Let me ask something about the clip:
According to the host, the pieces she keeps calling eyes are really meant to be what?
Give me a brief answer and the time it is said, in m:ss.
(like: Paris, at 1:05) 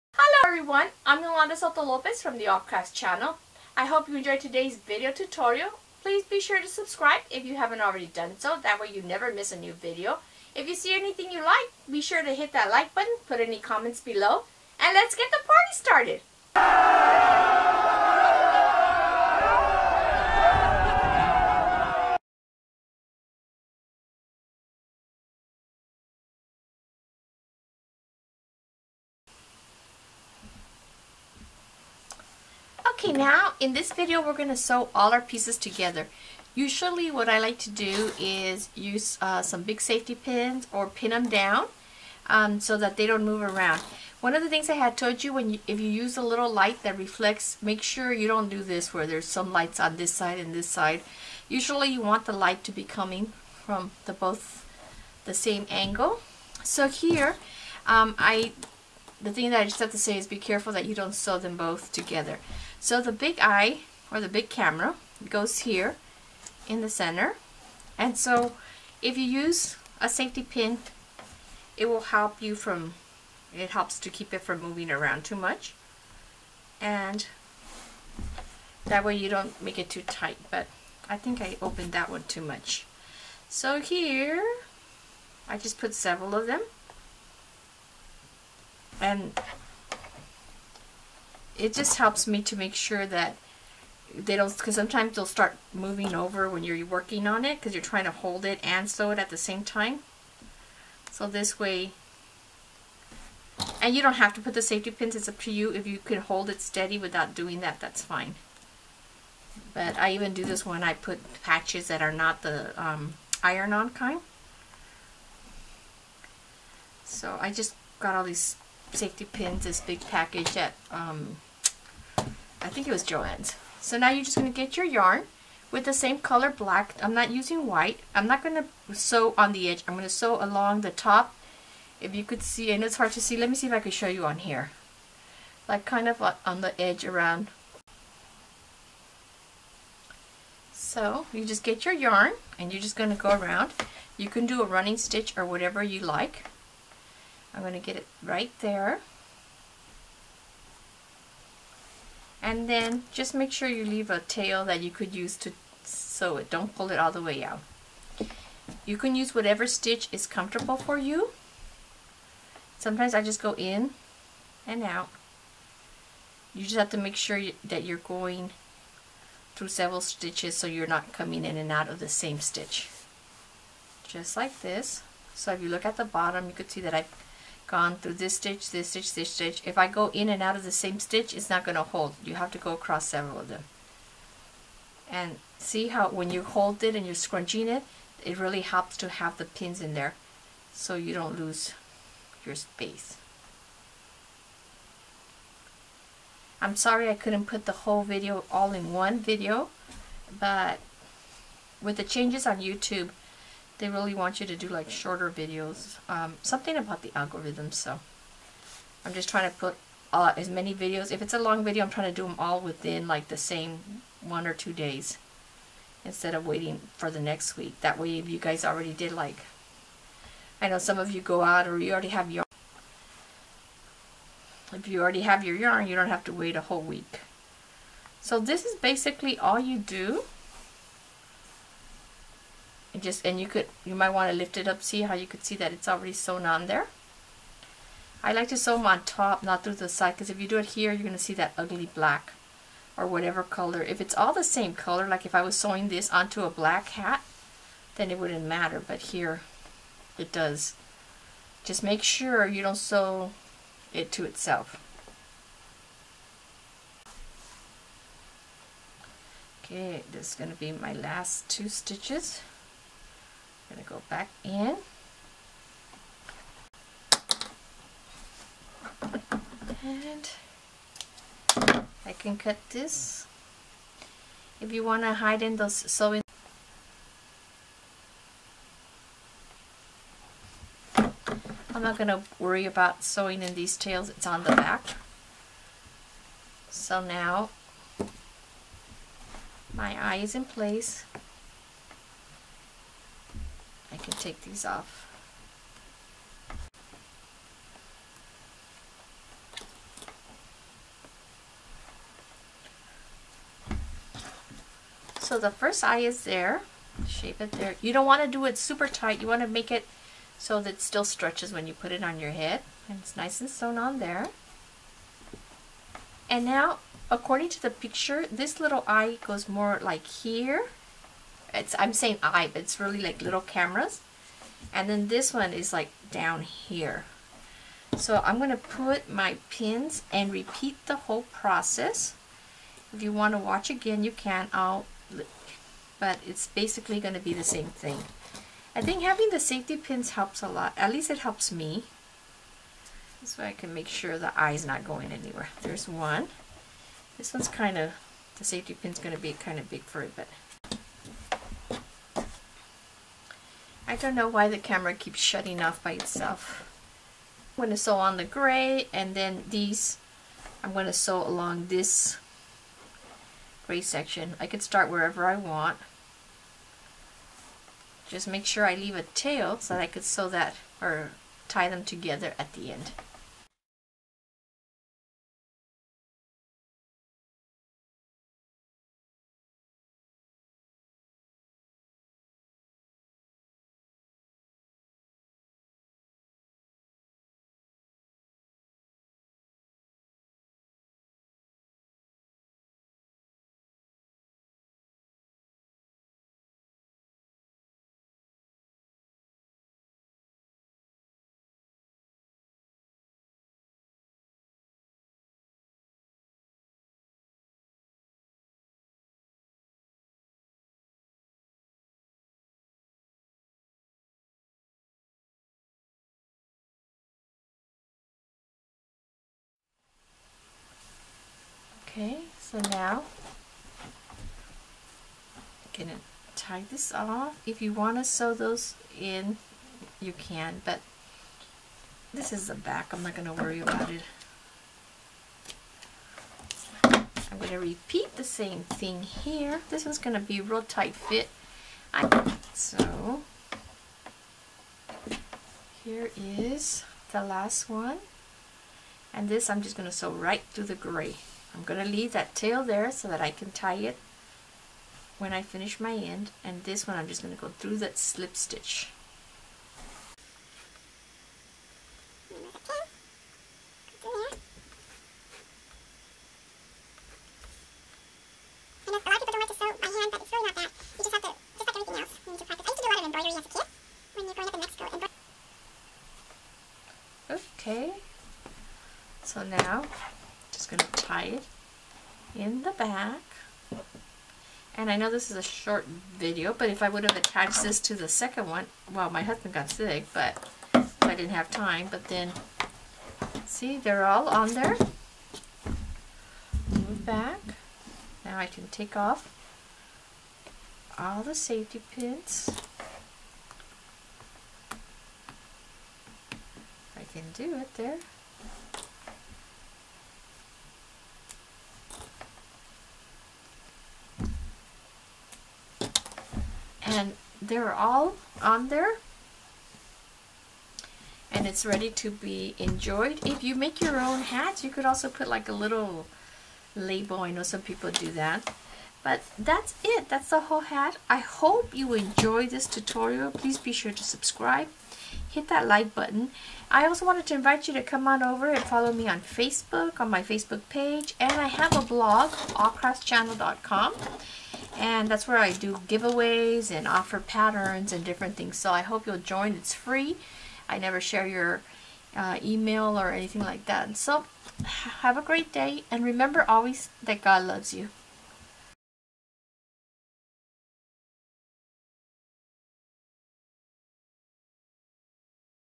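Little cameras, at 5:23.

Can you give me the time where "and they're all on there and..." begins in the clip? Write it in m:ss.
8:36.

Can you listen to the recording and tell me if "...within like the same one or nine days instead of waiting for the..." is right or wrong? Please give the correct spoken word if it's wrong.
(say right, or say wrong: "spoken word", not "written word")
wrong: "two", not "nine".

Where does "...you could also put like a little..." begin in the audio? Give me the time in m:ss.
8:44.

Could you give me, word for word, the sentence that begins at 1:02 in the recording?
So the big eye, or the big camera, goes here in the center.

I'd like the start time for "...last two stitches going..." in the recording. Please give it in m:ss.
4:20.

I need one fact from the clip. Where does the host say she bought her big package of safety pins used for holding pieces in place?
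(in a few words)
Jo-Ann's.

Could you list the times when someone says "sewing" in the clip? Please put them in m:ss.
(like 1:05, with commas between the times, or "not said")
4:05, 4:35, 4:43.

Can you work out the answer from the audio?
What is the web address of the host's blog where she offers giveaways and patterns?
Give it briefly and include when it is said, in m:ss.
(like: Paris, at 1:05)
AllCraftsChannel.com, at 9:02.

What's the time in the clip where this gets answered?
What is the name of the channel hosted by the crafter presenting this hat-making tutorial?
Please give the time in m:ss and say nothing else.
0:02.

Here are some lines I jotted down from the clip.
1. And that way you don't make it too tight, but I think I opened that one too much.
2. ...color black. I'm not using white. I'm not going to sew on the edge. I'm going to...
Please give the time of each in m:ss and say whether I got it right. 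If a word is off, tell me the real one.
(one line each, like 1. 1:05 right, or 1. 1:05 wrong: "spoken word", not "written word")
1. 1:16 right
2. 2:06 right.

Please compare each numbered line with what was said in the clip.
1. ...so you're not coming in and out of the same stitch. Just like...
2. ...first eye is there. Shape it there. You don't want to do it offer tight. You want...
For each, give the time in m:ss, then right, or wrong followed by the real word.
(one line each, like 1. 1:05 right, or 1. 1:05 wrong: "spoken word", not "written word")
1. 2:50 right
2. 5:05 wrong: "super", not "offer".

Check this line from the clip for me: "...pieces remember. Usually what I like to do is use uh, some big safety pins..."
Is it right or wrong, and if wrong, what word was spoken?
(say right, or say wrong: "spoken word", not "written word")
wrong: "together", not "remember".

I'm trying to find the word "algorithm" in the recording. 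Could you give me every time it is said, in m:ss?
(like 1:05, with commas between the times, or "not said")
3:27.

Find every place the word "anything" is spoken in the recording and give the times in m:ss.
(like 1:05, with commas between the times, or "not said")
0:10, 9:13.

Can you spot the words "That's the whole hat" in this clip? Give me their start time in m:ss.
8:50.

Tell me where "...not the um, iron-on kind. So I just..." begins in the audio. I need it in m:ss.
1:52.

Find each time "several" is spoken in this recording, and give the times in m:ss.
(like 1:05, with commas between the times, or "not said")
1:25, 2:49, 3:03.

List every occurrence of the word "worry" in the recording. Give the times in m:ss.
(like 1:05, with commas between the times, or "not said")
4:42, 7:13.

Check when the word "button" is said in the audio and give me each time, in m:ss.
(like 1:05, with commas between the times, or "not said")
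0:12, 8:55.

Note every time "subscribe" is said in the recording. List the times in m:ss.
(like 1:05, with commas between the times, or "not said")
0:06, 8:54.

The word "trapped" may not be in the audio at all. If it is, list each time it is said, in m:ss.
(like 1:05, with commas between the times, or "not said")
not said.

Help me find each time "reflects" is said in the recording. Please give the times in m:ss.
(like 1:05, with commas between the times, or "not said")
0:46.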